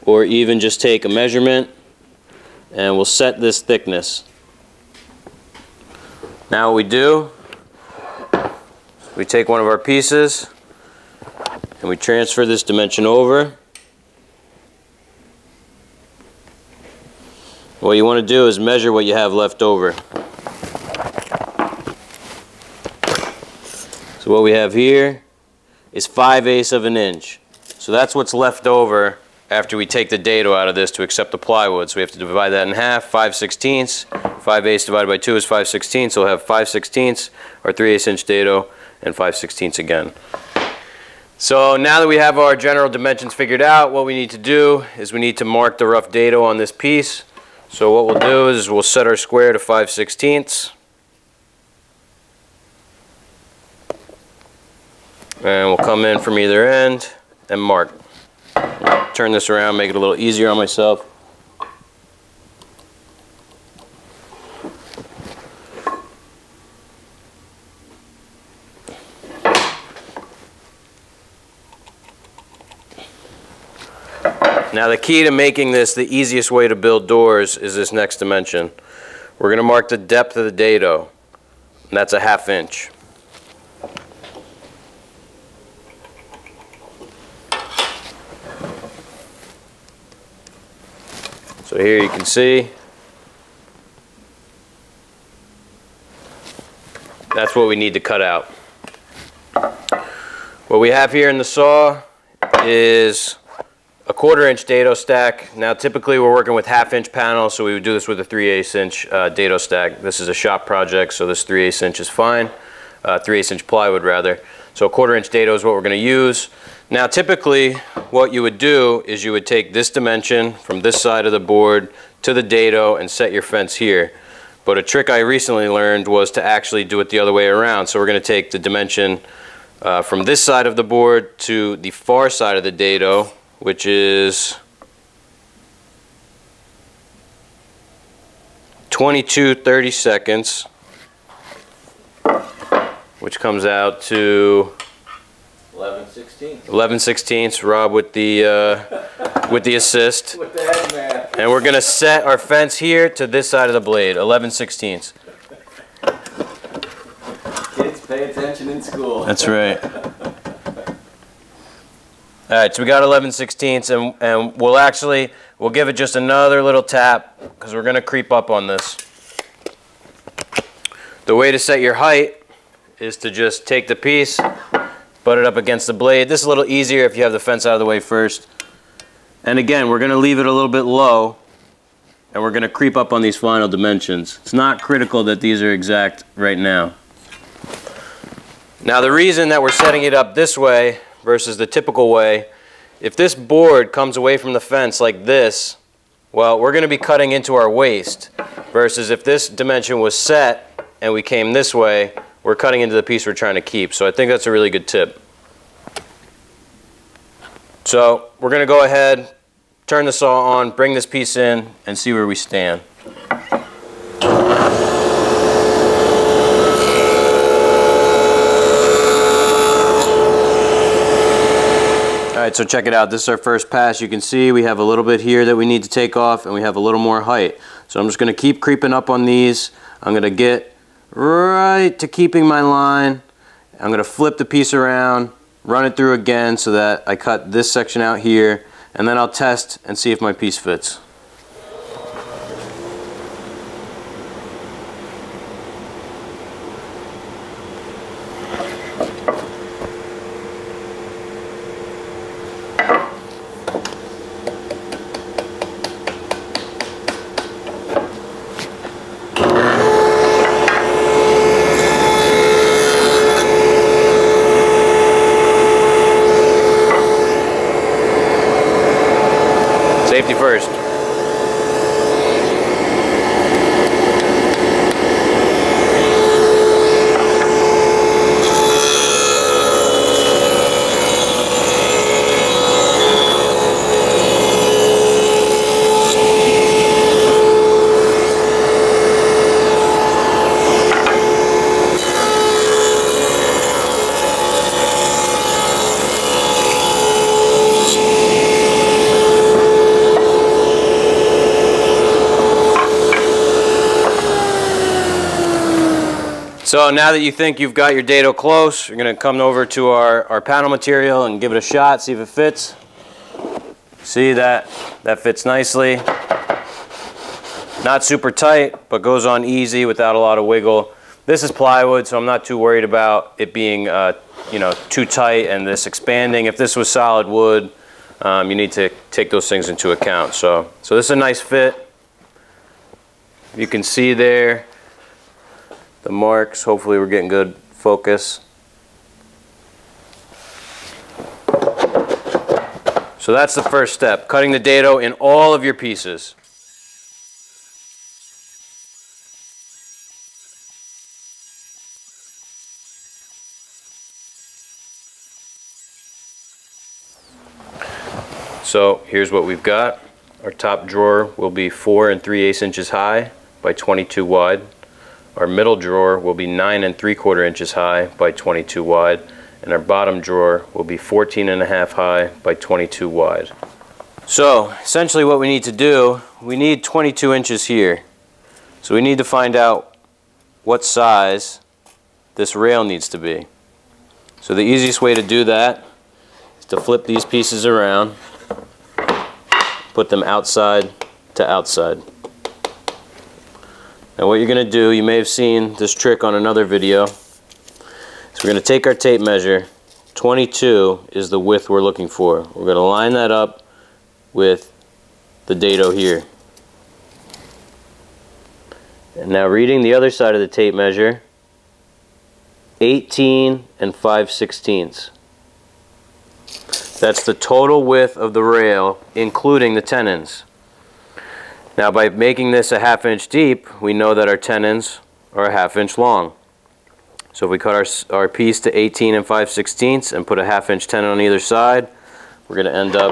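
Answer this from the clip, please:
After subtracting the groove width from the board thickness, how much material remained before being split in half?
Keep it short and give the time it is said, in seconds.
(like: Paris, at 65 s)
5/8 inch, at 26 s.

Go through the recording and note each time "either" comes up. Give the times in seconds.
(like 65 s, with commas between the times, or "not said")
56 s, 431 s.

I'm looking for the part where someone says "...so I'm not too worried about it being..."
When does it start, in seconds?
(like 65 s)
322 s.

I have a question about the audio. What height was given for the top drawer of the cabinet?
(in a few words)
4 3/8 inches.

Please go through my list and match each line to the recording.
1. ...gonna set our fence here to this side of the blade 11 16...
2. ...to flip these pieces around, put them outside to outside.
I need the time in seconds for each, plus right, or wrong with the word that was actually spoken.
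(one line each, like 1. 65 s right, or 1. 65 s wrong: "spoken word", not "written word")
1. 151 s right
2. 386 s right.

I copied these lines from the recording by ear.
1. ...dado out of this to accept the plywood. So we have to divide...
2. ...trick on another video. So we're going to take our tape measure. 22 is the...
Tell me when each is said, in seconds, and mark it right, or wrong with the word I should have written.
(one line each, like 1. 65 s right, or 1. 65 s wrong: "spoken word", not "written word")
1. 30 s right
2. 395 s right.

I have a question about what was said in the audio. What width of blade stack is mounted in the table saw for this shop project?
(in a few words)
1/4 inch.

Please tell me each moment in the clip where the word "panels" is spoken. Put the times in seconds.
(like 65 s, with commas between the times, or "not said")
107 s, 310 s.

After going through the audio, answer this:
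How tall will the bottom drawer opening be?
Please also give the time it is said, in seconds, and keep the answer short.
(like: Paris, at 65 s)
14 1/2 inches, at 370 s.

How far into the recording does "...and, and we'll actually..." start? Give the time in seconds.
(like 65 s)
163 s.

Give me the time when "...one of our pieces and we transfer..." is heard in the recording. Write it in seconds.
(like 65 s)
9 s.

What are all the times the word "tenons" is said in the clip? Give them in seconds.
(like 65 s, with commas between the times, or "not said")
419 s, 424 s, 430 s.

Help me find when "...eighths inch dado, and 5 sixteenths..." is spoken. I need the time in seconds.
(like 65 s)
37 s.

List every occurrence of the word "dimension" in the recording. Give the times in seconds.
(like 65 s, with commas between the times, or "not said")
12 s, 42 s, 78 s, 119 s, 128 s, 183 s, 199 s.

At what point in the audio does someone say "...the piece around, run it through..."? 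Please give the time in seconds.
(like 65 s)
234 s.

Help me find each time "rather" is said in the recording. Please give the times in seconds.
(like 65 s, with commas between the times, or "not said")
114 s.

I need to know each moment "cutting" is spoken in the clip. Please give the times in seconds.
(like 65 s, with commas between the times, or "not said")
196 s, 202 s, 344 s.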